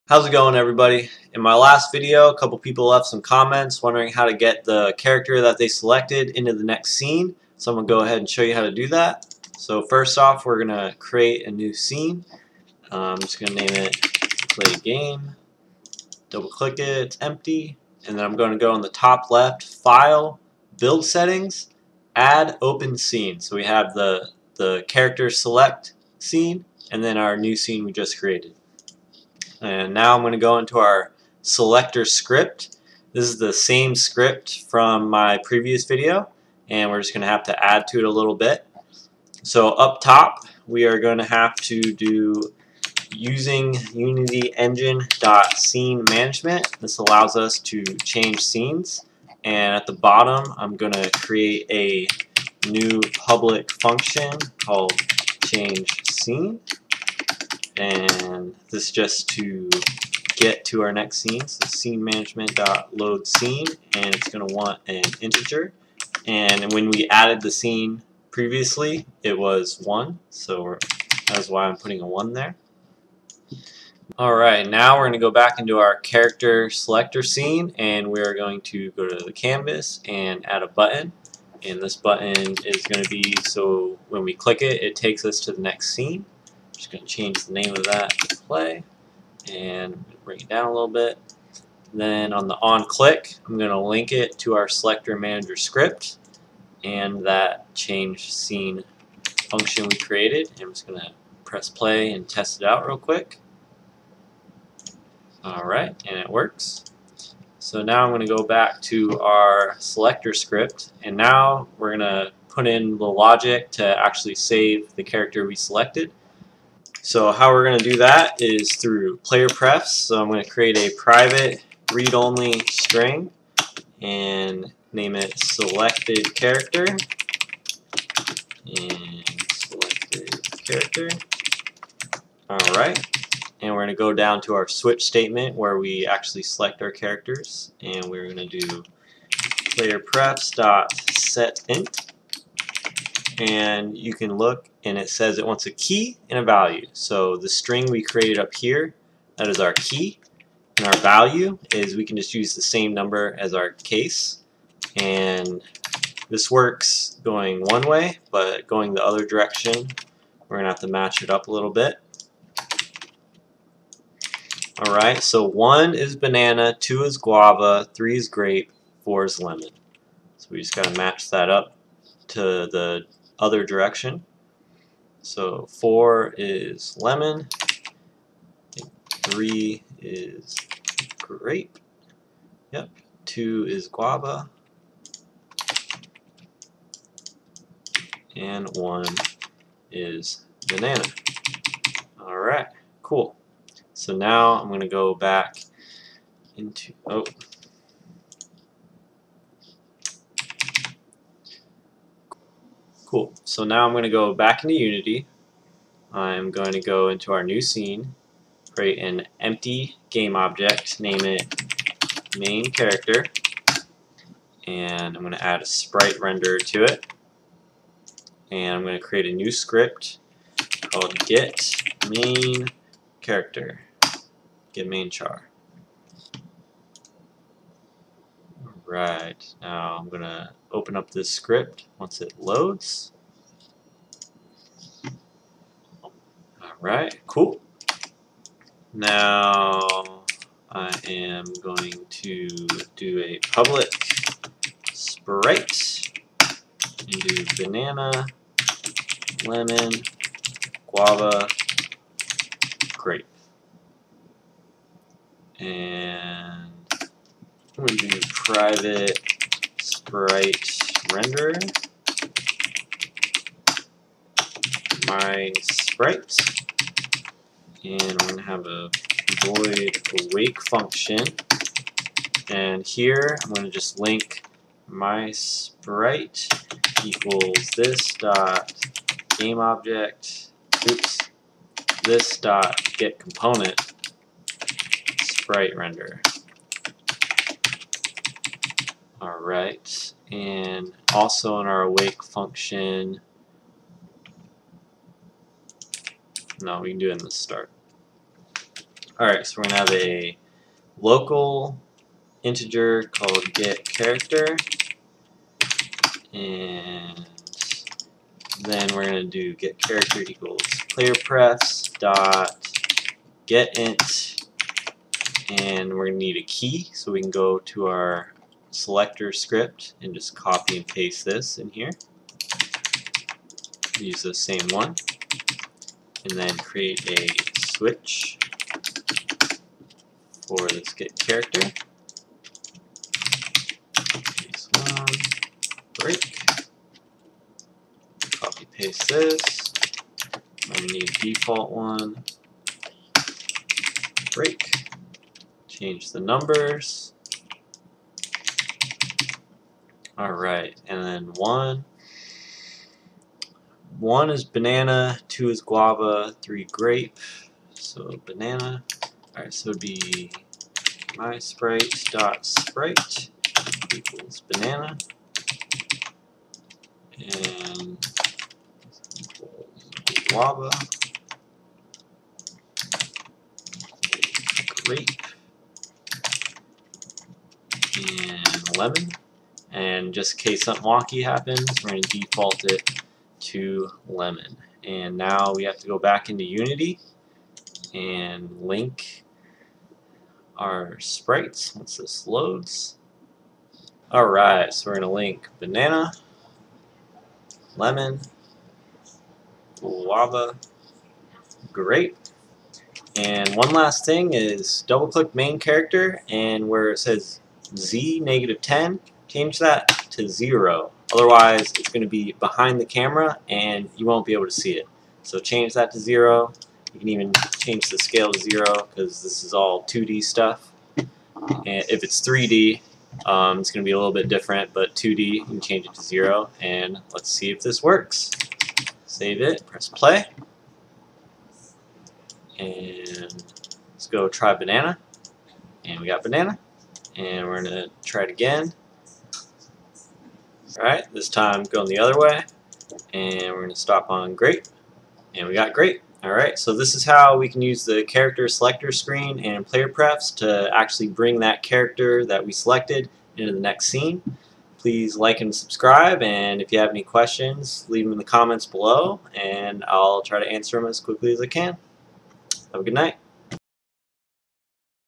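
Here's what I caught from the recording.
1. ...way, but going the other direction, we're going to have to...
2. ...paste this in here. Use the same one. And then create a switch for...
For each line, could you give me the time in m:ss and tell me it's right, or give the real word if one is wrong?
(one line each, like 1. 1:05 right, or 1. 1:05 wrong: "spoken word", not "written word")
1. 2:37 right
2. 5:20 right.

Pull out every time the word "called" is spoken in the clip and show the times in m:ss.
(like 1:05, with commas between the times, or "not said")
0:54, 3:40, 5:03.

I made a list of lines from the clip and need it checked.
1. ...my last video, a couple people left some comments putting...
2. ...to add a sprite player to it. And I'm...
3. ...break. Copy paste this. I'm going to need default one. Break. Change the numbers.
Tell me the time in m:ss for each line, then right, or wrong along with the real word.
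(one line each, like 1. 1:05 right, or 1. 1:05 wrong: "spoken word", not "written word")
1. 0:01 wrong: "wondering", not "putting"
2. 3:35 wrong: "render", not "player"
3. 5:35 right.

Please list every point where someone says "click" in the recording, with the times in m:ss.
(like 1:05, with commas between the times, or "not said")
0:16, 1:24, 1:32, 6:45.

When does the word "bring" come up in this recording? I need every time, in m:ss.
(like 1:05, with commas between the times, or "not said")
1:30, 7:31.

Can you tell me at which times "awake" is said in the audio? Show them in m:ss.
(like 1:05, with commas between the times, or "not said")
4:30, 4:51.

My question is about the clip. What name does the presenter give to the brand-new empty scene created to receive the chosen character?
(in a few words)
Play Game.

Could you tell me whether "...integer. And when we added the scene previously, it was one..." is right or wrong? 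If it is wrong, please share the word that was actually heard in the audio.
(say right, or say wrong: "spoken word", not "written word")
right.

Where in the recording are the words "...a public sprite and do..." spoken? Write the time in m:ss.
4:03.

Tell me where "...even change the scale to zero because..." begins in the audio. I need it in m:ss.
6:57.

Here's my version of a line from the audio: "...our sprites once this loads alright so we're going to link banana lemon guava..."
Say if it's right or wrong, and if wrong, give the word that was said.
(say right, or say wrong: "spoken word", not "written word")
right.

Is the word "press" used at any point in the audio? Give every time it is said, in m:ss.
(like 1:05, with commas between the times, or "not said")
1:41, 7:09.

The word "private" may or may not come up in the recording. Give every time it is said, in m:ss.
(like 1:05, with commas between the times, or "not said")
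2:00, 4:18.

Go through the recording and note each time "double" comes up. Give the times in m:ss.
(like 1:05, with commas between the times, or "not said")
0:16, 6:44.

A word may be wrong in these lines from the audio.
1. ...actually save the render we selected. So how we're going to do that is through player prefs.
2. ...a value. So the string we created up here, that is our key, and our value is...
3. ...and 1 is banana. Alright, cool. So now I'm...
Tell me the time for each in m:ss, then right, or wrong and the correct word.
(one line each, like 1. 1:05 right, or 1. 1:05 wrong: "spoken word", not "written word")
1. 1:54 wrong: "character", not "render"
2. 2:26 right
3. 3:08 right.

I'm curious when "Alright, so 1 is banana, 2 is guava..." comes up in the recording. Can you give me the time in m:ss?
2:44.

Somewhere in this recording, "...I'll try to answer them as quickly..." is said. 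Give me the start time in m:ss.
7:39.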